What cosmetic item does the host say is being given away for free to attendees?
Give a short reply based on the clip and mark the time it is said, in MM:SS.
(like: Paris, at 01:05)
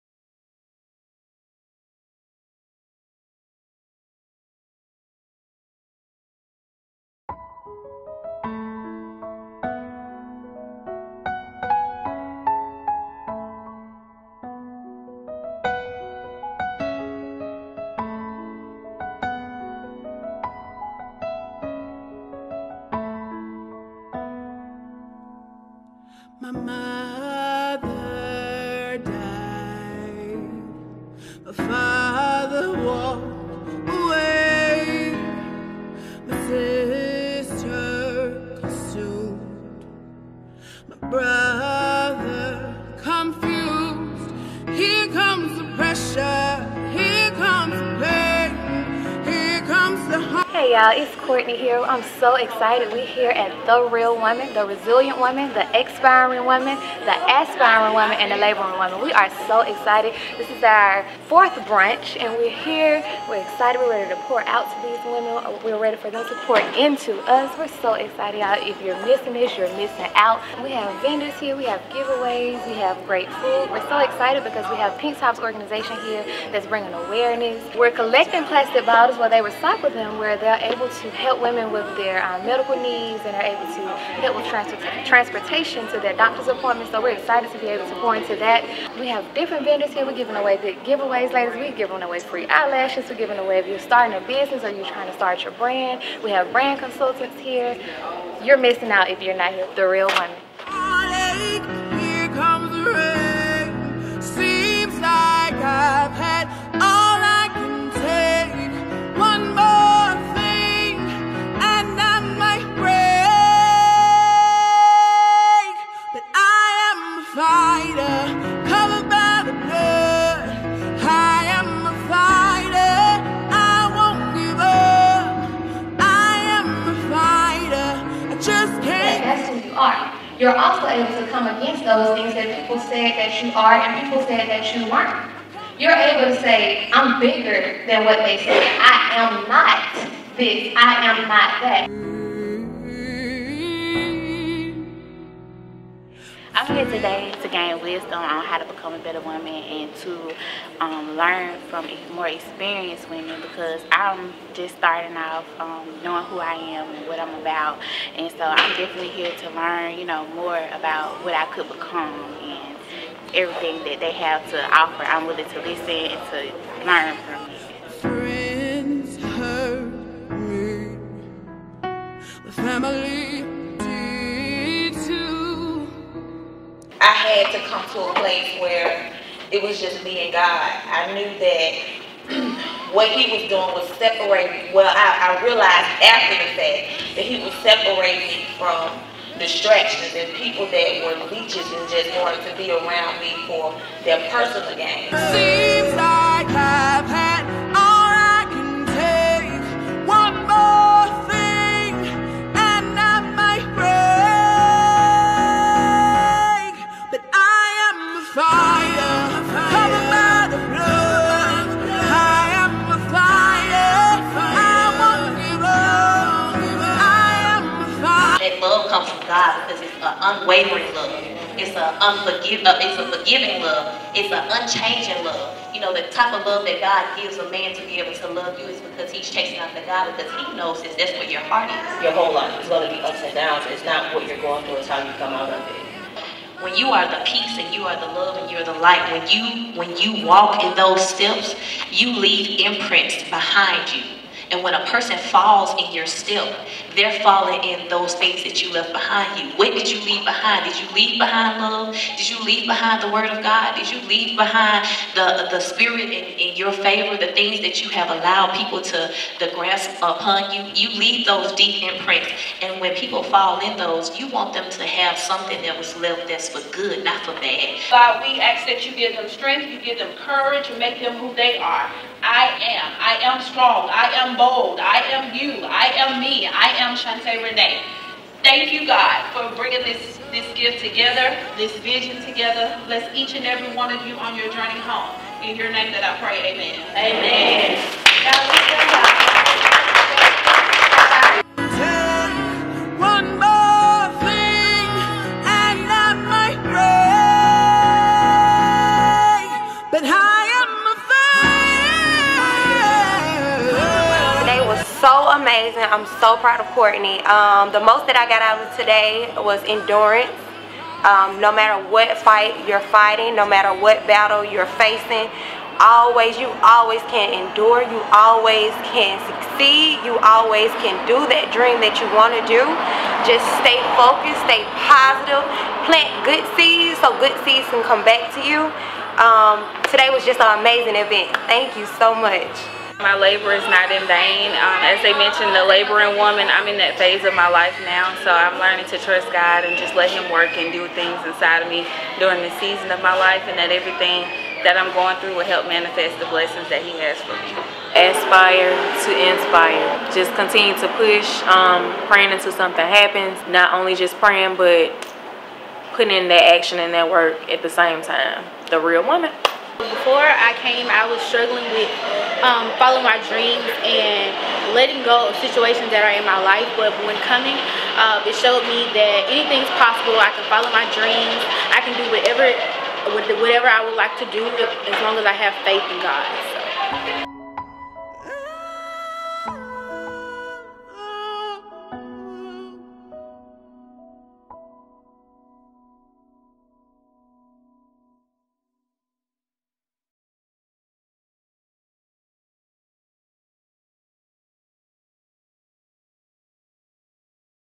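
eyelashes, at 01:32.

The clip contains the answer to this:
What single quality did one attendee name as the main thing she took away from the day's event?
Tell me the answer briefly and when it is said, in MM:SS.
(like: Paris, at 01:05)
endurance, at 05:09.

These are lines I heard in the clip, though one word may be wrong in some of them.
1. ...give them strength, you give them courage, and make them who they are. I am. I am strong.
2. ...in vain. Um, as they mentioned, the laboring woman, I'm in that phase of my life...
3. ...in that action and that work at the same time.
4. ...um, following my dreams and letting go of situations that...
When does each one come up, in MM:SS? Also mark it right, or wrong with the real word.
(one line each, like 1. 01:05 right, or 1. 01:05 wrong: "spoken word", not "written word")
1. 04:28 right
2. 05:33 right
3. 05:56 right
4. 06:02 right.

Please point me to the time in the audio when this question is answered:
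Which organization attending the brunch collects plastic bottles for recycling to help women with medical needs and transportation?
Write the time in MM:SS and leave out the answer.
01:14.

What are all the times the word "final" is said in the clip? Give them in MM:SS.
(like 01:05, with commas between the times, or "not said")
not said.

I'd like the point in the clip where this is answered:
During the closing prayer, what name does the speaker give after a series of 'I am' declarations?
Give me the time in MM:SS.
04:36.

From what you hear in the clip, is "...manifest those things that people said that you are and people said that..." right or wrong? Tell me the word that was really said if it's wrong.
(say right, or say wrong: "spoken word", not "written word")
wrong: "against", not "manifest".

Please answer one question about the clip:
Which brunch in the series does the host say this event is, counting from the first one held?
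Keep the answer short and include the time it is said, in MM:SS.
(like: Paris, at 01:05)
fourth, at 01:01.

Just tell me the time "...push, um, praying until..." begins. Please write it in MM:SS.
05:51.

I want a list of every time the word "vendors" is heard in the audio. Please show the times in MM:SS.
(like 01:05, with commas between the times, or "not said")
01:11, 01:29.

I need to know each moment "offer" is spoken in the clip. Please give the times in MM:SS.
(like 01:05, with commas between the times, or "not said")
02:44.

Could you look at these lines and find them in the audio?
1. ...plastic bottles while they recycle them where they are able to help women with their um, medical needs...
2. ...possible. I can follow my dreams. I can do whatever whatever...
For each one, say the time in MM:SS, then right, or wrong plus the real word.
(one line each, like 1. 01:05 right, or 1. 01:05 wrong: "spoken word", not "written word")
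1. 01:18 right
2. 06:09 right.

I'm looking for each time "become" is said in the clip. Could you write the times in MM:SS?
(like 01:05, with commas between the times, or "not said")
02:28, 02:41.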